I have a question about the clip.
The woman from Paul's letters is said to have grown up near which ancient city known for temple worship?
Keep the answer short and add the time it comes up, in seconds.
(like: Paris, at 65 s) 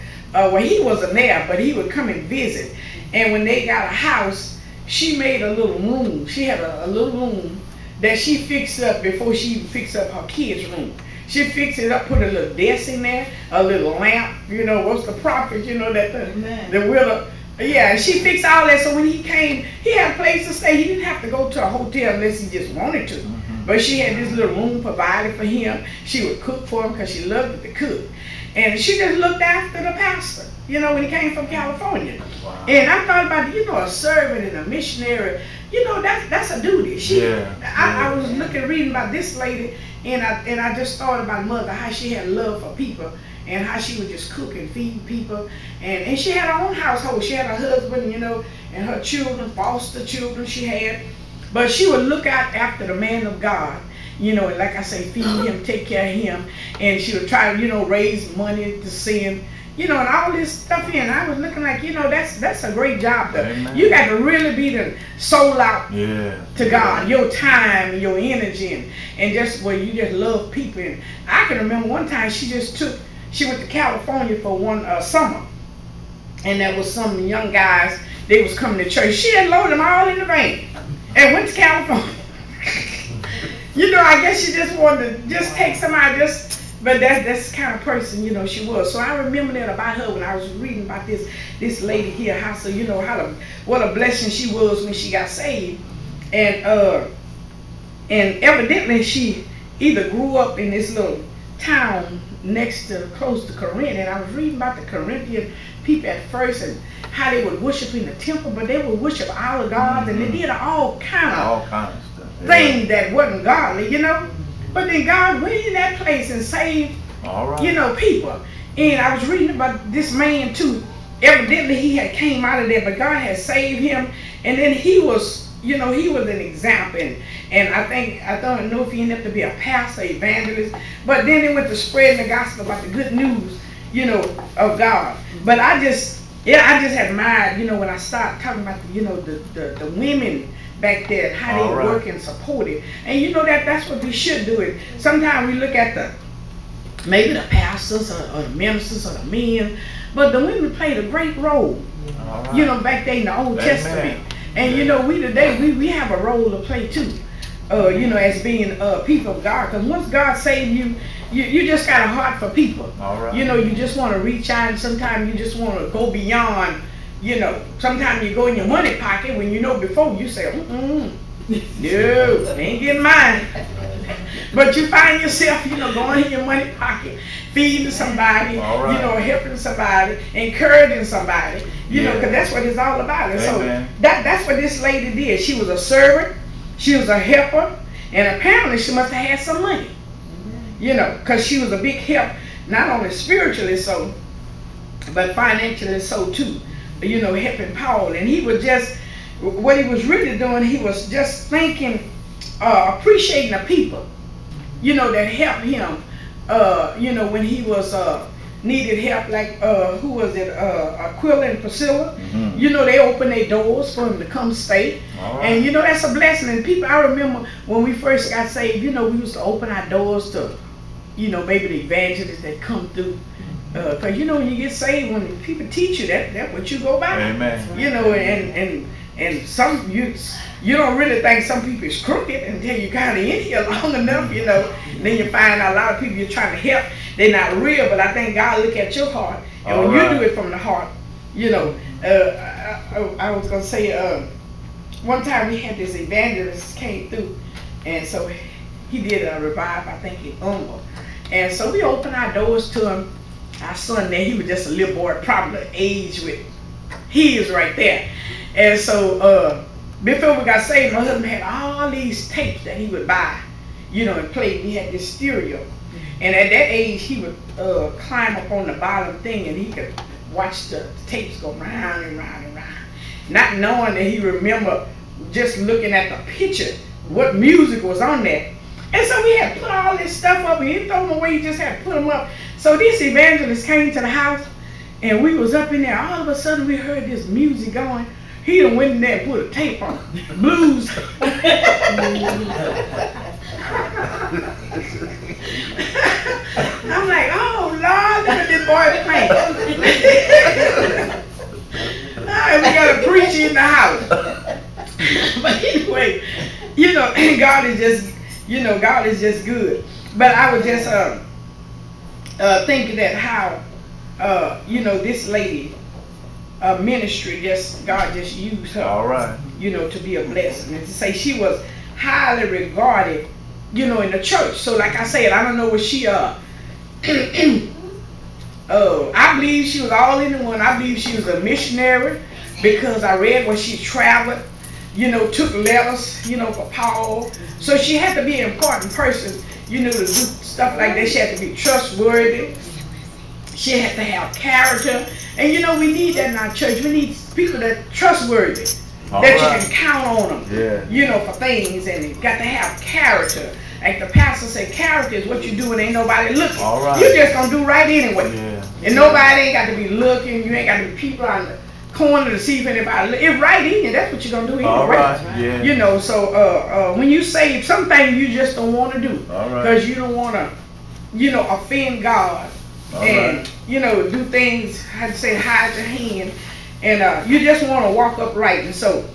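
Corinth, at 103 s.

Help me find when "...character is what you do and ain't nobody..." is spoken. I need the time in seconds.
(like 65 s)
354 s.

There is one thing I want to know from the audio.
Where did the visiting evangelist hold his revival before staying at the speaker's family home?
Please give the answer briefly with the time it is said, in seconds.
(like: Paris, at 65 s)
Humble, at 250 s.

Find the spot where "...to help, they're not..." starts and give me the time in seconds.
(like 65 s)
236 s.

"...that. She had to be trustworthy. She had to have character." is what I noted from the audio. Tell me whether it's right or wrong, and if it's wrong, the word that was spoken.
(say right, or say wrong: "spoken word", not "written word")
right.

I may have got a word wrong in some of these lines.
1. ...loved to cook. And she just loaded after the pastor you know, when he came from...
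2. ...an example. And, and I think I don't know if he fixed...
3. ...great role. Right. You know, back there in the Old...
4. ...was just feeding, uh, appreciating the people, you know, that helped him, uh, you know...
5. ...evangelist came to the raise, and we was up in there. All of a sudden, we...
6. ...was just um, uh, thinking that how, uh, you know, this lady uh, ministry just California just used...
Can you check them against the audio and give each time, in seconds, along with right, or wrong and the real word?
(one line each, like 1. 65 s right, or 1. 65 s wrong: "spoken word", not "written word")
1. 27 s wrong: "looked", not "loaded"
2. 126 s wrong: "ended", not "fixed"
3. 151 s right
4. 200 s wrong: "thinking", not "feeding"
5. 283 s wrong: "house", not "raise"
6. 310 s wrong: "God", not "California".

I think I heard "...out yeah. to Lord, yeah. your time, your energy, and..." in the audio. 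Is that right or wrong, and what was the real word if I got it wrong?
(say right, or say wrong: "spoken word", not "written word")
wrong: "God", not "Lord".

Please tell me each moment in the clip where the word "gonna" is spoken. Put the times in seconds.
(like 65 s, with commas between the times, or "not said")
243 s, 364 s.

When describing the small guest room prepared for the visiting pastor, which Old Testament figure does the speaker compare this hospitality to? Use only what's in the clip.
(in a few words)
The widow.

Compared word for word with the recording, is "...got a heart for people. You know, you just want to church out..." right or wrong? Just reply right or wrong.
wrong.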